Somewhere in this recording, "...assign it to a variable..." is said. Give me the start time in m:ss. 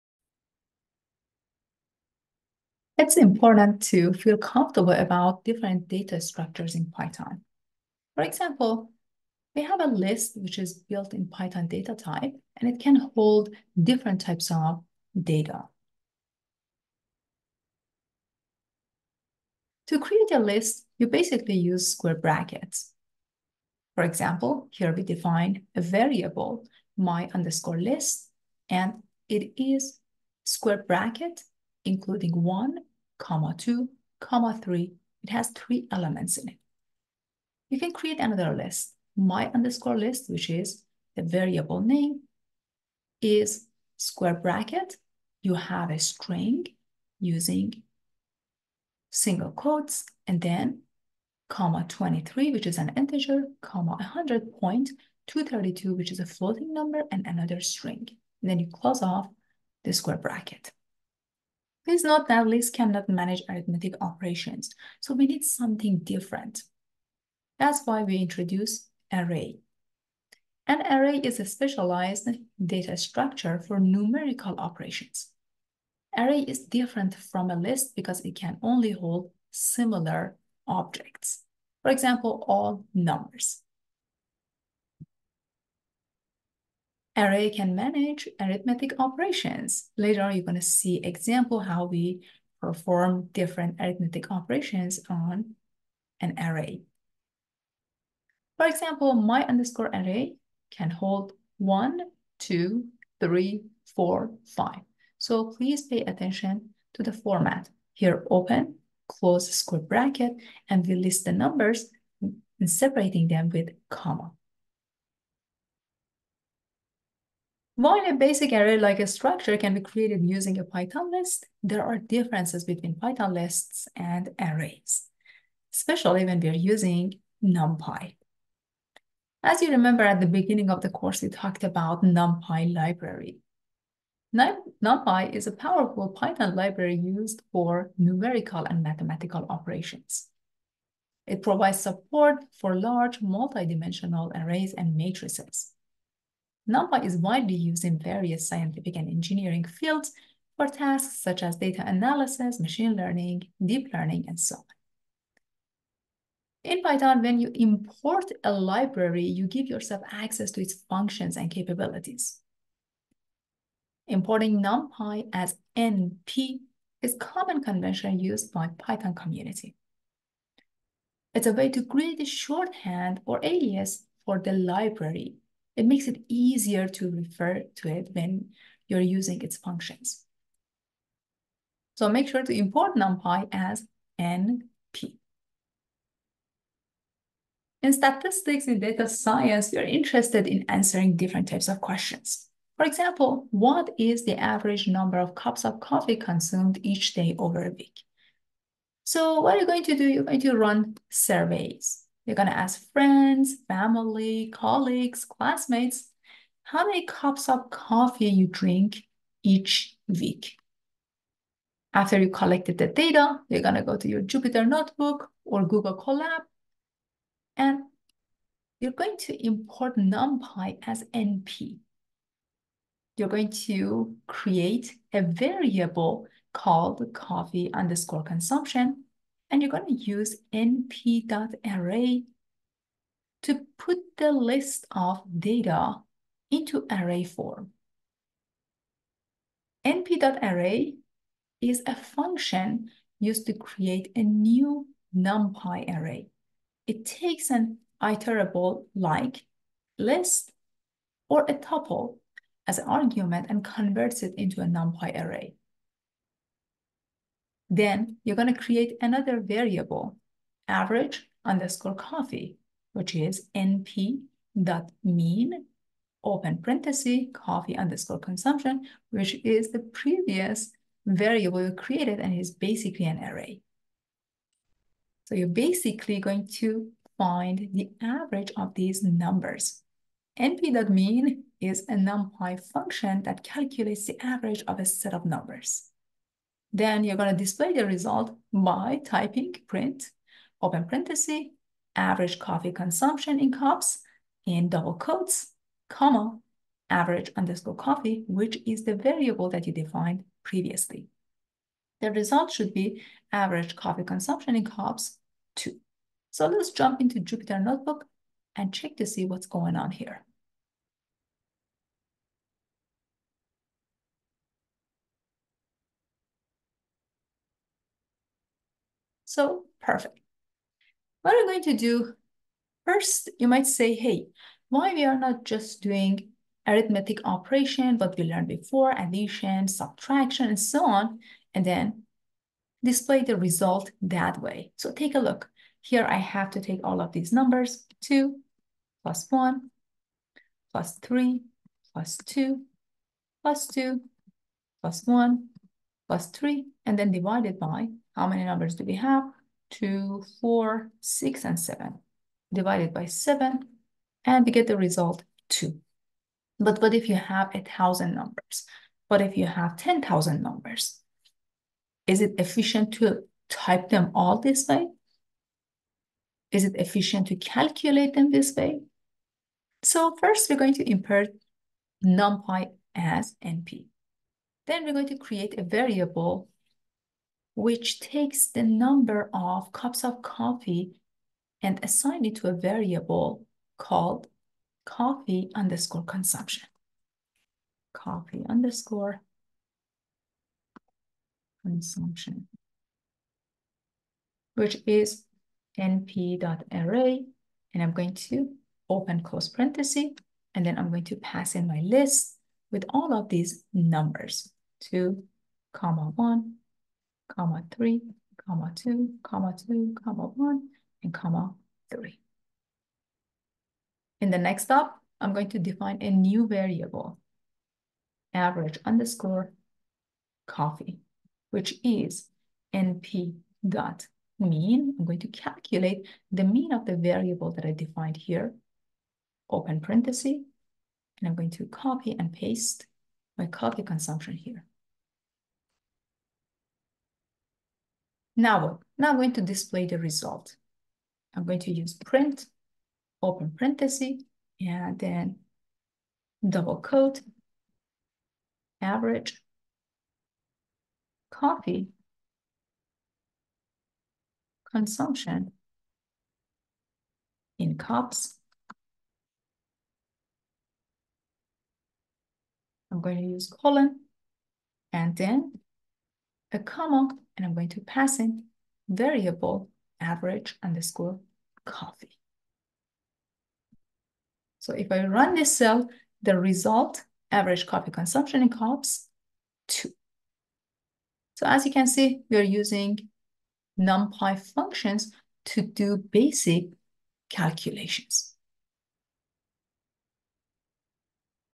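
6:21.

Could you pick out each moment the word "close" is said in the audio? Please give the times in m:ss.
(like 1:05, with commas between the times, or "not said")
0:58, 1:49, 6:39.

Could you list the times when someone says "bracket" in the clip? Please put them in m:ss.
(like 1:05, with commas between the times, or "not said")
0:22, 0:30, 0:44, 1:00, 1:49.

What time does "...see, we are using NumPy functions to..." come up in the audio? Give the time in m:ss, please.
8:01.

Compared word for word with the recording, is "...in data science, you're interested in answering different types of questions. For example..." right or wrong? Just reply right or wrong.
right.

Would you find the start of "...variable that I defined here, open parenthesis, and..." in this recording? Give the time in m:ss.
7:06.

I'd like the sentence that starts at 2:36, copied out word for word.
In Python, when you import a library, you give yourself access to its functions and capabilities.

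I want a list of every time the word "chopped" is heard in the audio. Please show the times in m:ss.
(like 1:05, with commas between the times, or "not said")
not said.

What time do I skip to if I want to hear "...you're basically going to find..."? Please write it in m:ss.
4:35.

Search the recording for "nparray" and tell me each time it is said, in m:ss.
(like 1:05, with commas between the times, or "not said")
3:50, 3:59, 6:35.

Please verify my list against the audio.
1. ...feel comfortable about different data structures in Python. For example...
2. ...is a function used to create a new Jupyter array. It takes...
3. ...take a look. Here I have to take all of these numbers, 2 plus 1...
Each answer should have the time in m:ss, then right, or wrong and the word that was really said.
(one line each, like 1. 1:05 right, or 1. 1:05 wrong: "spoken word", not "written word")
1. 0:04 right
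2. 4:01 wrong: "NumPy", not "Jupyter"
3. 5:34 right.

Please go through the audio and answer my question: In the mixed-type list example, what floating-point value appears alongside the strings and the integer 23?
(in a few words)
100.232.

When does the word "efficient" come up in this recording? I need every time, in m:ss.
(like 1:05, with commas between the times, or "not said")
6:02, 6:06.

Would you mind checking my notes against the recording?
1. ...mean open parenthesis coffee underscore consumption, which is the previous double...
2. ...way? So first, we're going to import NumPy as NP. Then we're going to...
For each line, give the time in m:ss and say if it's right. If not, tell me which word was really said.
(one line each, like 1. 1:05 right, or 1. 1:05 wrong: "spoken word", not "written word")
1. 4:25 wrong: "variable", not "double"
2. 6:08 right.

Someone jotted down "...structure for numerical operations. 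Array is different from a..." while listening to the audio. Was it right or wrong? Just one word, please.
right.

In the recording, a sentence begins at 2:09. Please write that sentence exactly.
As you remember at the beginning of the course, we talked about NumPy library.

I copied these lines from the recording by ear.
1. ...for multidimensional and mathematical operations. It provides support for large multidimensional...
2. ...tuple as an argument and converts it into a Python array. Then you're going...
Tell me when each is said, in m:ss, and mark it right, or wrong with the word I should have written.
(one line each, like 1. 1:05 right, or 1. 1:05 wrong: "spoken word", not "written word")
1. 2:17 wrong: "numerical", not "multidimensional"
2. 4:11 wrong: "NumPy", not "Python".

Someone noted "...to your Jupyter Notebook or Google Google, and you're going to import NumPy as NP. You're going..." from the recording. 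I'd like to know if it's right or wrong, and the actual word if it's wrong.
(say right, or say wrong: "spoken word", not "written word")
wrong: "Colab", not "Google".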